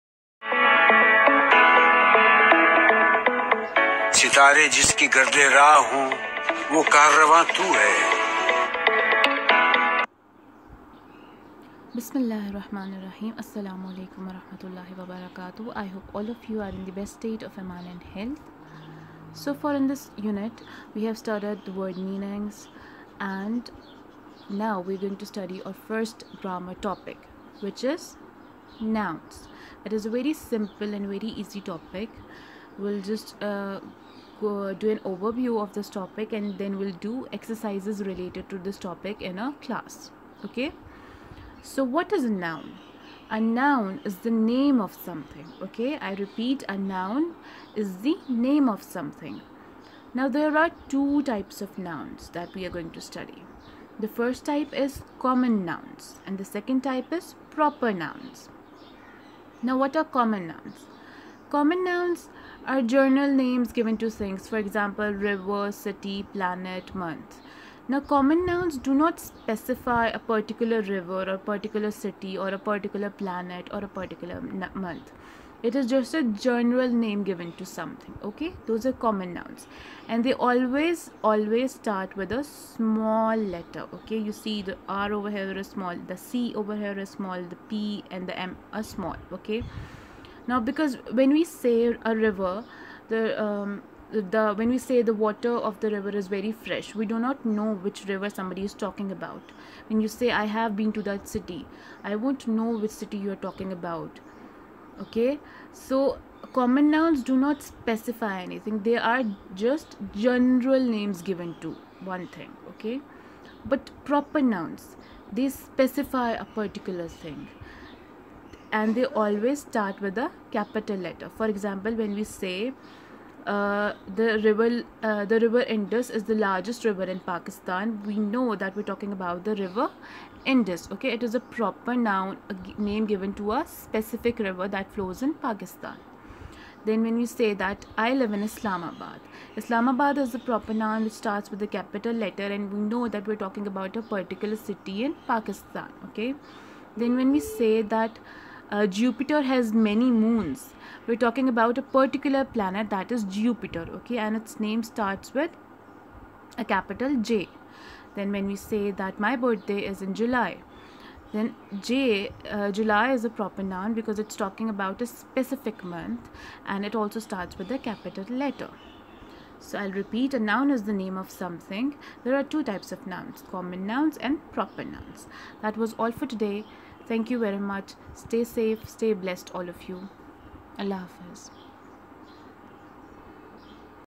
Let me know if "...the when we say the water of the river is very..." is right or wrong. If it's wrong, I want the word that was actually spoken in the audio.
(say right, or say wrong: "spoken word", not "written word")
right.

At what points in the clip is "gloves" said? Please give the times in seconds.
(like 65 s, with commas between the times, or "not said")
not said.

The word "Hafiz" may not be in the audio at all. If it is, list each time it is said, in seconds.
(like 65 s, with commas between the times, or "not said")
181 s.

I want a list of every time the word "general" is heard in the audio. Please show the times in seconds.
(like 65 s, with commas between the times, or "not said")
76 s, 110 s.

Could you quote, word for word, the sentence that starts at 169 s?
So I'll repeat a noun is the name of something.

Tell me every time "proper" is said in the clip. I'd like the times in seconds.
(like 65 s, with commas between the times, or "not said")
57 s, 114 s, 131 s, 140 s, 163 s, 174 s.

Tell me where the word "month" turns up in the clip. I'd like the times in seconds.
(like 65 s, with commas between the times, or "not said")
66 s, 74 s, 165 s.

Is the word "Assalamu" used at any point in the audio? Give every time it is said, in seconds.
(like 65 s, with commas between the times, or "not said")
13 s.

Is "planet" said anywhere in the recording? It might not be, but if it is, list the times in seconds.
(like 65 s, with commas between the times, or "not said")
66 s, 73 s, 152 s.